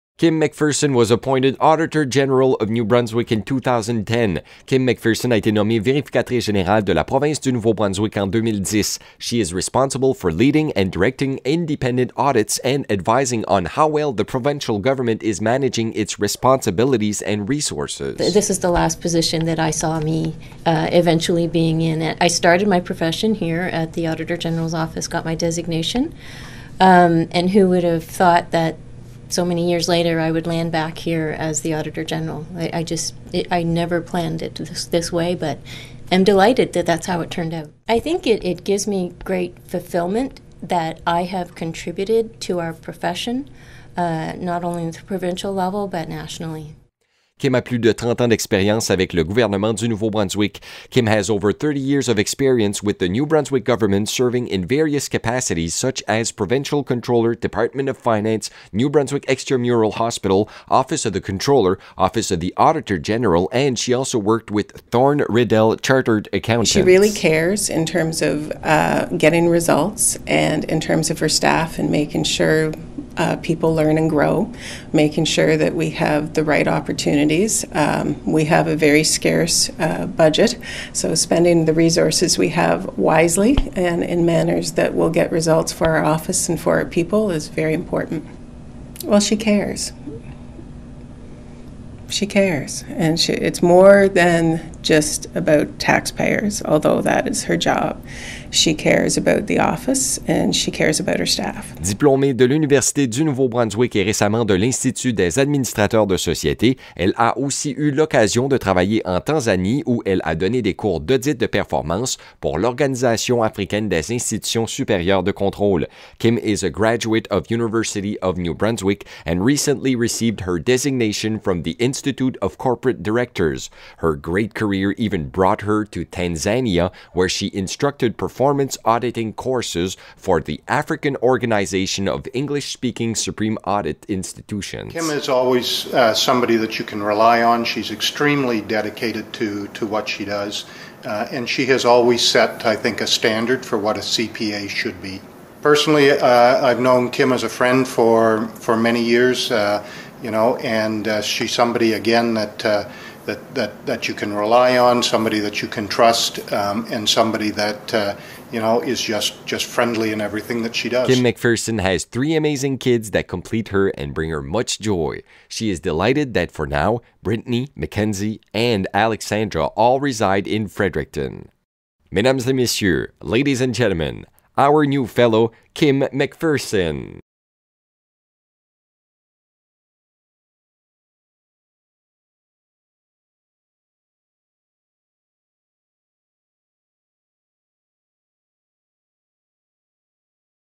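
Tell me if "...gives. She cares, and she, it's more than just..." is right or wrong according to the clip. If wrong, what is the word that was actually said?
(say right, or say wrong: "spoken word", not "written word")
wrong: "cares", not "gives".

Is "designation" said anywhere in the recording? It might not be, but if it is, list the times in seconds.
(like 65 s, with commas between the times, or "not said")
25 s, 120 s.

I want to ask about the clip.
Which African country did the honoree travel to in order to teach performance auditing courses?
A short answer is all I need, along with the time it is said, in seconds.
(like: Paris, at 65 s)
Tanzania, at 126 s.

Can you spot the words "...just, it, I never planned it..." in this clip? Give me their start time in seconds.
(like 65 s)
32 s.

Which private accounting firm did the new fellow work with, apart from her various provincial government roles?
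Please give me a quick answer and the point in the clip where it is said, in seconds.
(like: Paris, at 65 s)
Thorne Riddell Chartered Accountants, at 64 s.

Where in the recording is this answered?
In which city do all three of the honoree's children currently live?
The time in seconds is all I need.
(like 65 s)
170 s.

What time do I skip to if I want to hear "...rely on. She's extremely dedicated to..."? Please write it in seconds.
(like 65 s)
137 s.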